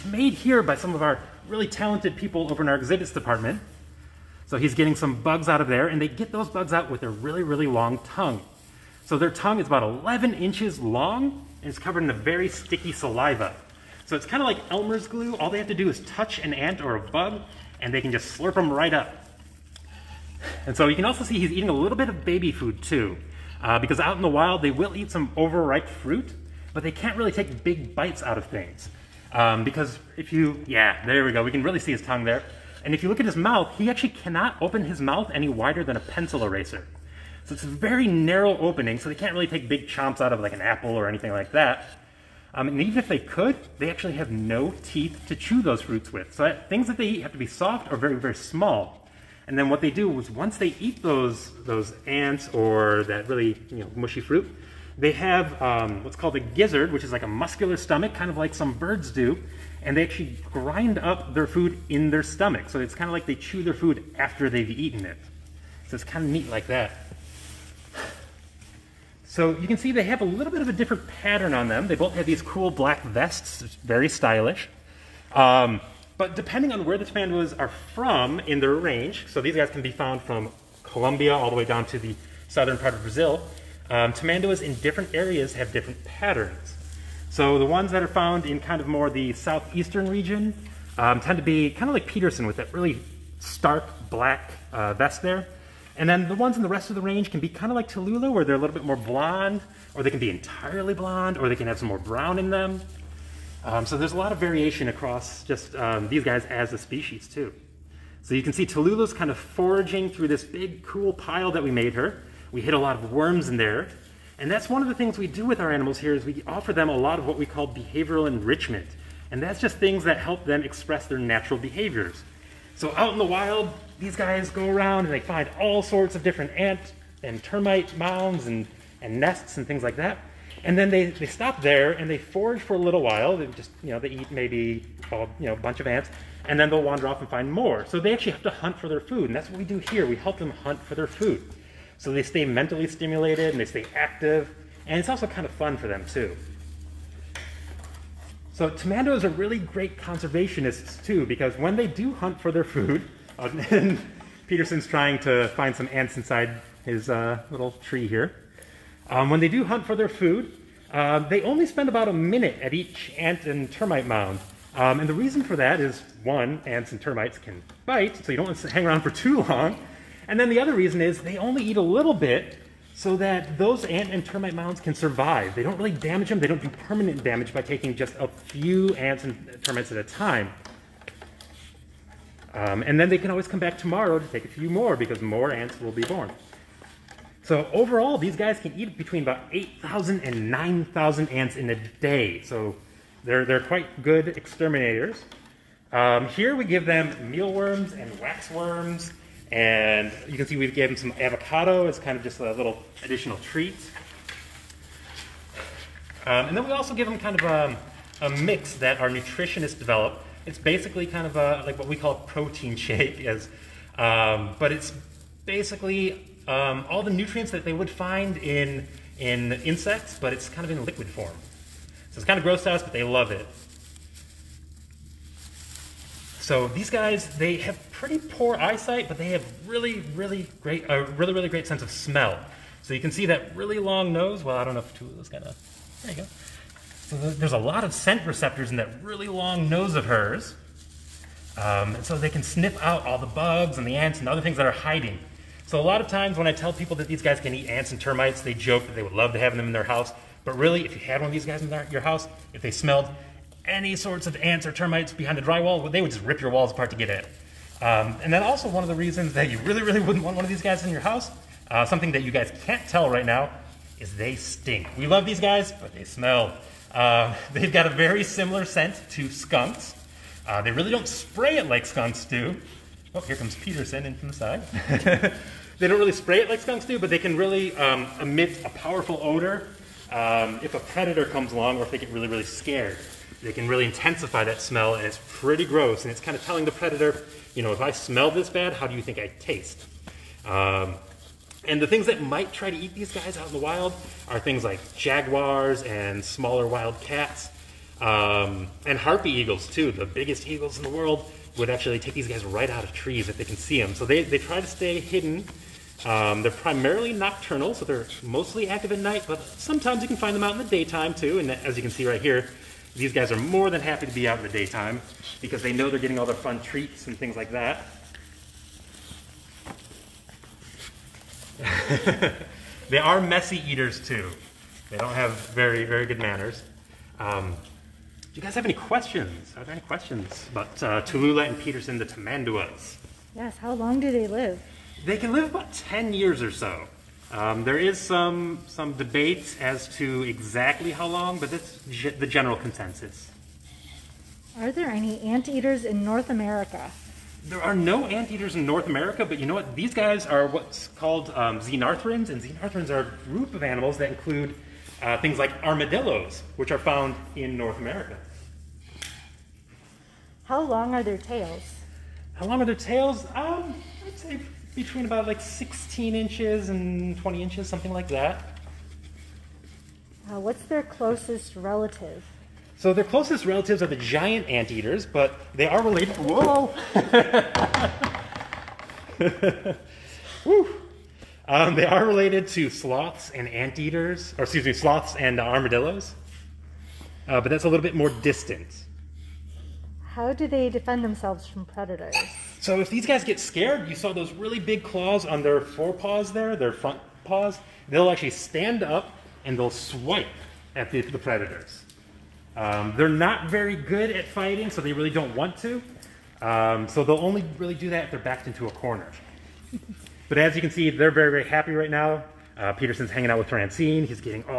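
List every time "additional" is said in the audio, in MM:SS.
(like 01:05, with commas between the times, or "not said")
03:23.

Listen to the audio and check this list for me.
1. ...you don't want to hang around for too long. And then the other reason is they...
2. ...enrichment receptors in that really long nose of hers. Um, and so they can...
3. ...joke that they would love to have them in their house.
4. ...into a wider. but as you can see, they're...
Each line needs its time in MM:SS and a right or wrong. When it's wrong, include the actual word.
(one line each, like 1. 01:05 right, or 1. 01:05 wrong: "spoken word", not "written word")
1. 02:48 right
2. 03:57 wrong: "scent", not "enrichment"
3. 04:08 right
4. 06:48 wrong: "corner", not "wider".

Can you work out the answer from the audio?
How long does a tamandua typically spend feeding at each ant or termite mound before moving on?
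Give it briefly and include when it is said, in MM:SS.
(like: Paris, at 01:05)
about a minute, at 02:41.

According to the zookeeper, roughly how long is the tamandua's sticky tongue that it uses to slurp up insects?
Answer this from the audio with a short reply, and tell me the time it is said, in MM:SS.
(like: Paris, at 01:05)
11 inches, at 00:09.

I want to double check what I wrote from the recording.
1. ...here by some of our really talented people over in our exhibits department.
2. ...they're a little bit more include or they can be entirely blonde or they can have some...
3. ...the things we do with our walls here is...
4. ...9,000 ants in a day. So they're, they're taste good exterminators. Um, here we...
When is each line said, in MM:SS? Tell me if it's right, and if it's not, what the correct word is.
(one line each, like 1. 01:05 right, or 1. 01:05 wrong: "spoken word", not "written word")
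1. 00:00 right
2. 01:38 wrong: "blonde", not "include"
3. 01:54 wrong: "animals", not "walls"
4. 03:10 wrong: "quite", not "taste".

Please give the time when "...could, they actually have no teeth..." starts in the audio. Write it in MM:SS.
00:43.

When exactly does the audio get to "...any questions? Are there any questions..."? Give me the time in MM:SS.
05:28.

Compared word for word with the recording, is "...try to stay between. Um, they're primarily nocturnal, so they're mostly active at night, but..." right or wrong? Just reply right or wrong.
wrong.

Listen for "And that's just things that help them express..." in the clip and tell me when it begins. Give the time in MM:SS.
01:59.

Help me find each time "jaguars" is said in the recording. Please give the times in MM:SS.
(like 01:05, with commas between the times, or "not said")
04:54.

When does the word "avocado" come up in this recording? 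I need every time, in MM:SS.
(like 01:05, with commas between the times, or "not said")
03:21.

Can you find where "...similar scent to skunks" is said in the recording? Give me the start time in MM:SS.
04:28.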